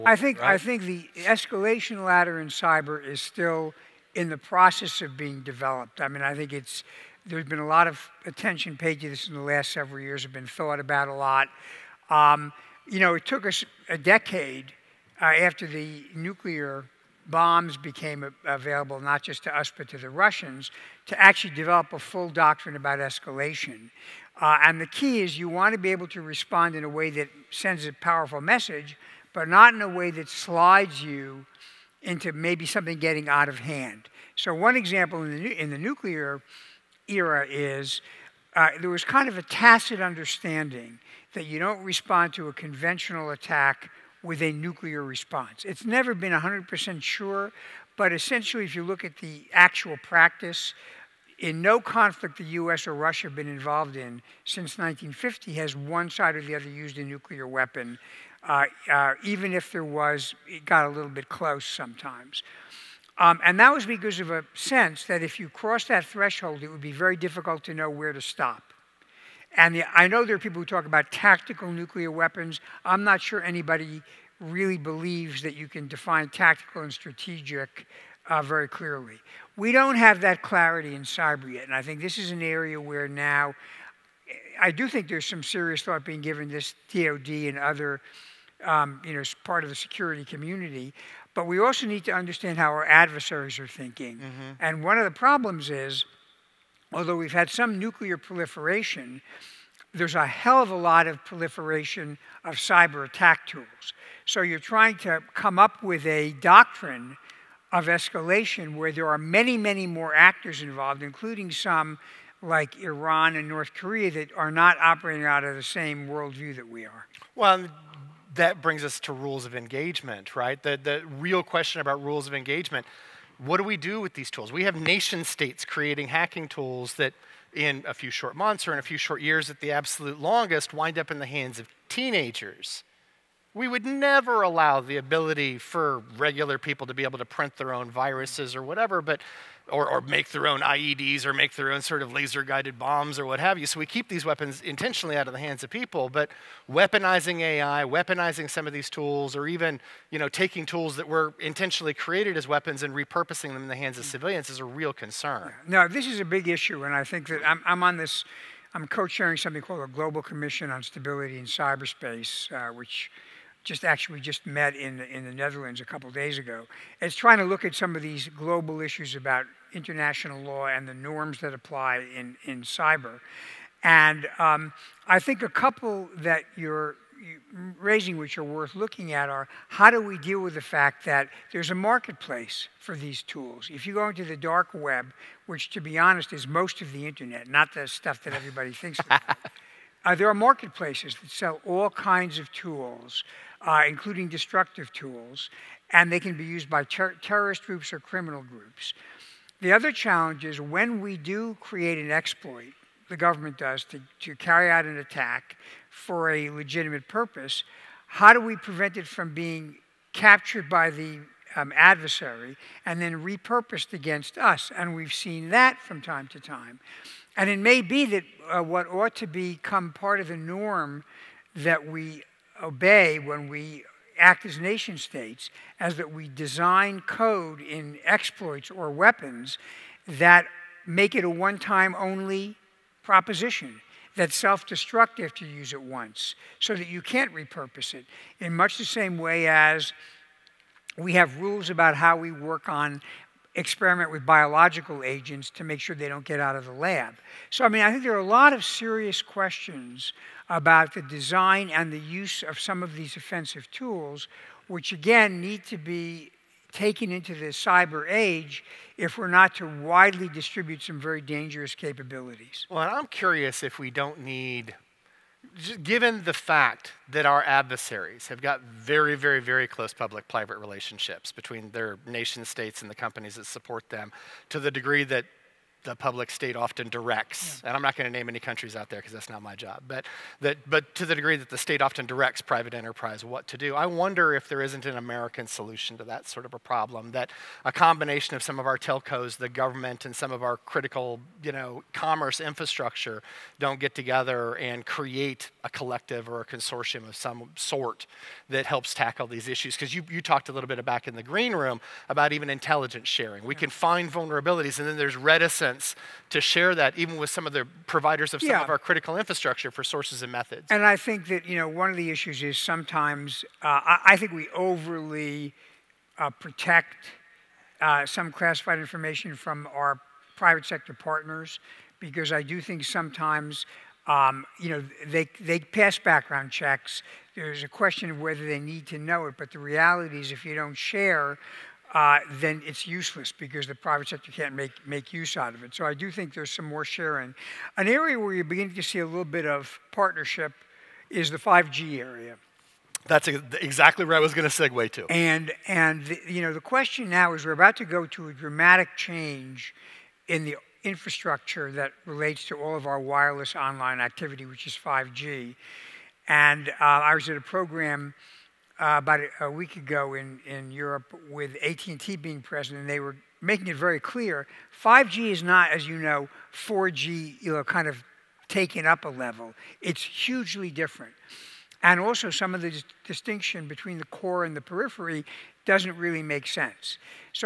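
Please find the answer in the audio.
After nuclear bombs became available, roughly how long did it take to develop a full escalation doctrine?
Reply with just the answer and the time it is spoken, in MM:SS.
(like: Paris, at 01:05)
A decade, at 00:13.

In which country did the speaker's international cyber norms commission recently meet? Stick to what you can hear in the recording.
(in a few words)
The Netherlands.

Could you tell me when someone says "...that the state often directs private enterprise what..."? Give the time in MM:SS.
04:41.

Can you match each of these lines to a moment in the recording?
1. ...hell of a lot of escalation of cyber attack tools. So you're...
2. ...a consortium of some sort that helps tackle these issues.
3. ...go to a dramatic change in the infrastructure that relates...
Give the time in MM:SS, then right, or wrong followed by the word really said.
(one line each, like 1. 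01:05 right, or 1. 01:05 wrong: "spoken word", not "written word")
1. 01:40 wrong: "proliferation", not "escalation"
2. 04:56 right
3. 05:47 right.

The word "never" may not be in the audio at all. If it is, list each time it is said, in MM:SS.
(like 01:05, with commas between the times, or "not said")
00:45, 02:13.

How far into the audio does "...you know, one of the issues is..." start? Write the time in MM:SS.
05:11.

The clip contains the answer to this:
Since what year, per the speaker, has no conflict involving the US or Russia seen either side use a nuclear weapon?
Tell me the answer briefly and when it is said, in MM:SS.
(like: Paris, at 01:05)
1950, at 00:54.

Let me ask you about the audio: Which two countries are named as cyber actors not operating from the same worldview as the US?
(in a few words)
Iran and North Korea.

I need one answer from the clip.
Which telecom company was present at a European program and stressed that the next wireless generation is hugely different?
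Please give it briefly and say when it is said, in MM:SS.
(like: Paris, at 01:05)
AT&T, at 06:01.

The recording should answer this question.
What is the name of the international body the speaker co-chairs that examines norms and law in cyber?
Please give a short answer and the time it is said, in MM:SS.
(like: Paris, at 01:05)
Global Commission on Stability in Cyberspace, at 02:39.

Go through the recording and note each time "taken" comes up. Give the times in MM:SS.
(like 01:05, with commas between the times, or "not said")
04:16, 06:08.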